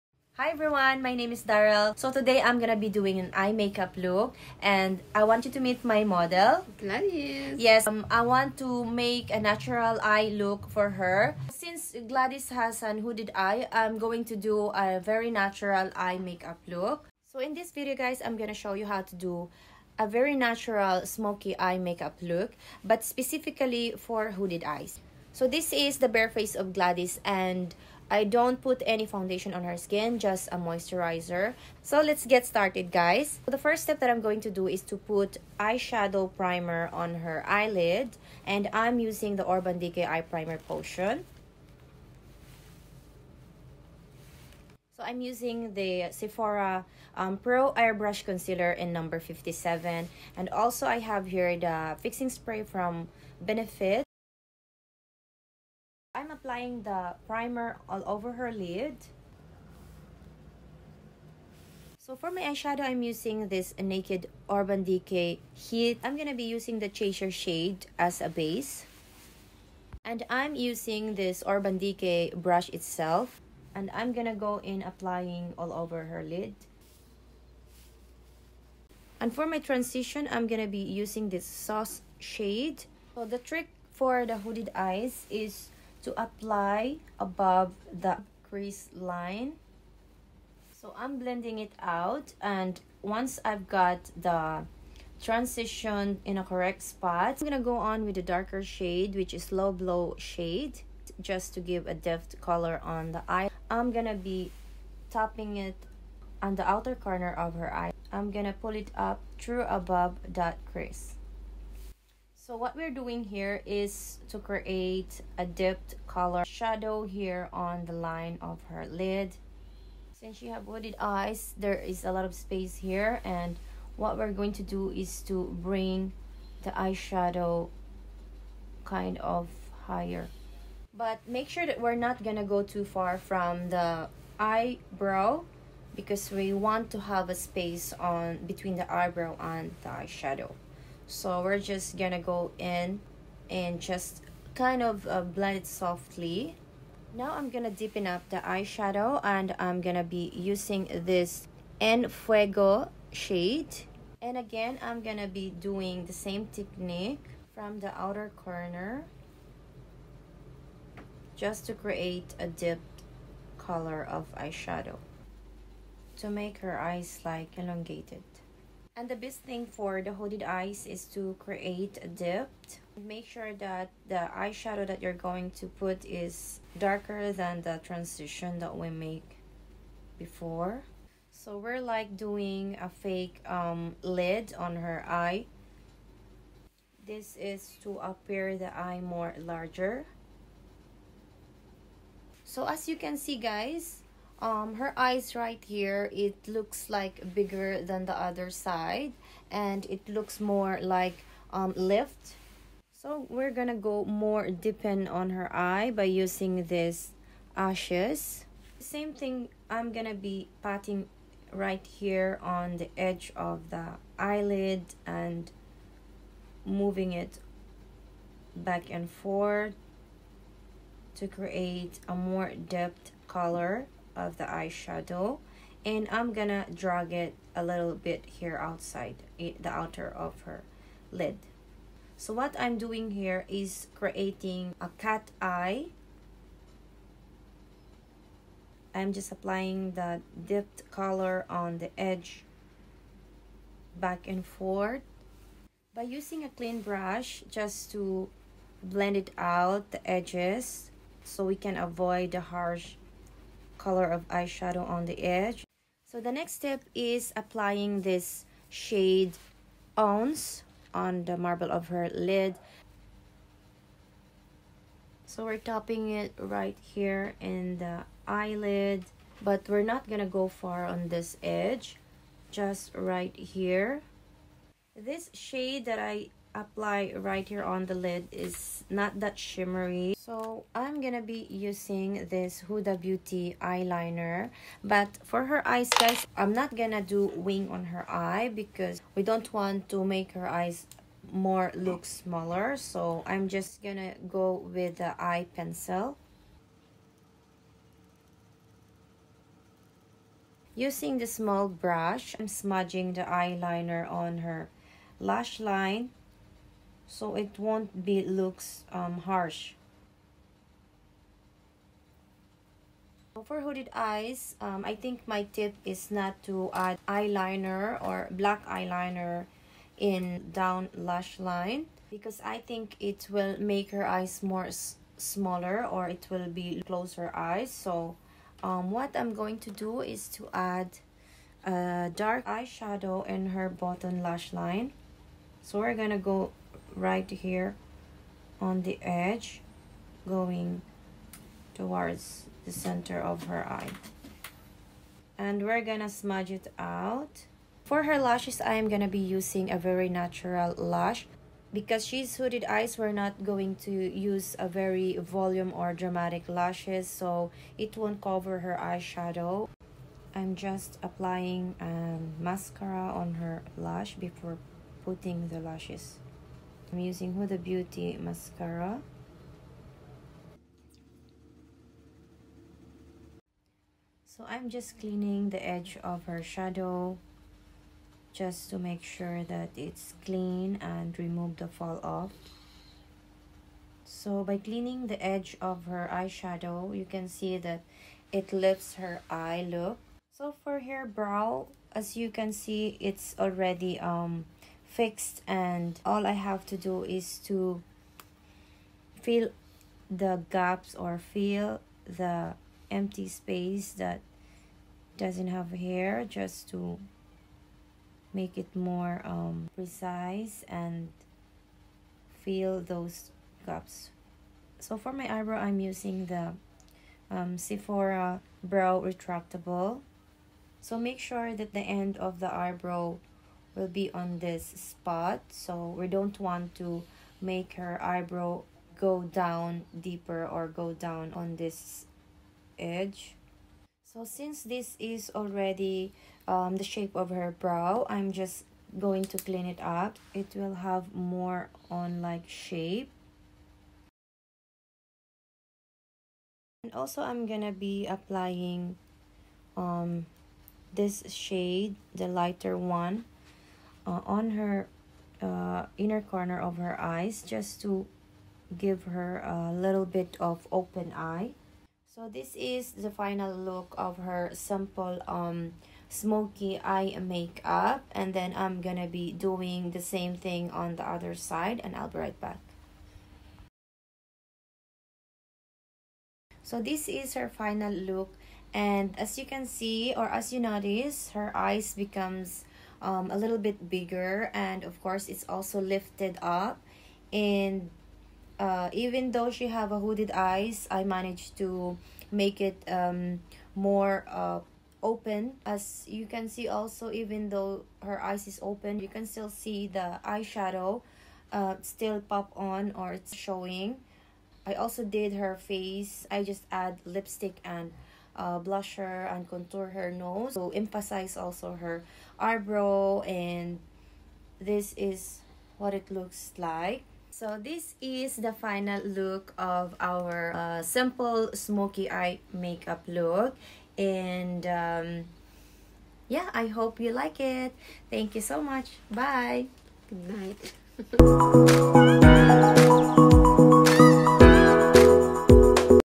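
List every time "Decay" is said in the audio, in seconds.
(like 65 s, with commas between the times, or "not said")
39 s, 64 s, 71 s.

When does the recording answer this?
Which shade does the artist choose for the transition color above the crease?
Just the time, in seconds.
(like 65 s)
81 s.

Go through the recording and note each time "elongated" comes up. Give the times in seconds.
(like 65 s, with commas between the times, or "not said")
167 s.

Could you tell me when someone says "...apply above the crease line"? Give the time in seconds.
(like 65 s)
86 s.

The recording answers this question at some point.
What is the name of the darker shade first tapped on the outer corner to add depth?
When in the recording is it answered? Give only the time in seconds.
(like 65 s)
99 s.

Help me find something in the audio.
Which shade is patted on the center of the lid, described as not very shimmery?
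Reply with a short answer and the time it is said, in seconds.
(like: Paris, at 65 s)
Ounce, at 259 s.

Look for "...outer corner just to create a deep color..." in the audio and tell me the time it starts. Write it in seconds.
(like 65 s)
158 s.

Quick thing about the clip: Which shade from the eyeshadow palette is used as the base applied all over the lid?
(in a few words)
Chaser.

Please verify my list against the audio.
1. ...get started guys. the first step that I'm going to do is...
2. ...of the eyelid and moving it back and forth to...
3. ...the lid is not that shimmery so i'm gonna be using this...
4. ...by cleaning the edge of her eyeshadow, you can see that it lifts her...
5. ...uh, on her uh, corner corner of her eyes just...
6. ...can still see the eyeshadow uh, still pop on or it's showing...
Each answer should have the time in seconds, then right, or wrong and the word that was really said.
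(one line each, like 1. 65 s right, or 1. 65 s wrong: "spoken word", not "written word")
1. 32 s right
2. 213 s right
3. 277 s right
4. 384 s right
5. 454 s wrong: "inner", not "corner"
6. 499 s right.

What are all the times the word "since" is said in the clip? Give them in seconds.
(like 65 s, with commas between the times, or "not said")
11 s, 120 s, 434 s.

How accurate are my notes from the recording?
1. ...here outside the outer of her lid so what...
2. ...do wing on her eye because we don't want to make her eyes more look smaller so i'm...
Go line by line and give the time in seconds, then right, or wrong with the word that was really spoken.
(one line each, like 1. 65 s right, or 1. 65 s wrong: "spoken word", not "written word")
1. 228 s right
2. 287 s right.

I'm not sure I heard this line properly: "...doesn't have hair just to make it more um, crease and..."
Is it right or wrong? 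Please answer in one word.
wrong.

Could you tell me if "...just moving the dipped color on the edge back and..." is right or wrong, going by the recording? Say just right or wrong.
wrong.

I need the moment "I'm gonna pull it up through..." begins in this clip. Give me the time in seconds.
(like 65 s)
108 s.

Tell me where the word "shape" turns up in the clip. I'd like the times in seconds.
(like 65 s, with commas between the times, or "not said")
436 s, 442 s.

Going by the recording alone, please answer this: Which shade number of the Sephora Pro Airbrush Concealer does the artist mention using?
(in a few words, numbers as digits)
57.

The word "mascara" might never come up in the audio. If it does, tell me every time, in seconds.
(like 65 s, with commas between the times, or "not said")
362 s, 368 s.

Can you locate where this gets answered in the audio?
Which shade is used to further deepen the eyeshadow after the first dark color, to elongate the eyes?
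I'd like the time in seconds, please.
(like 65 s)
151 s.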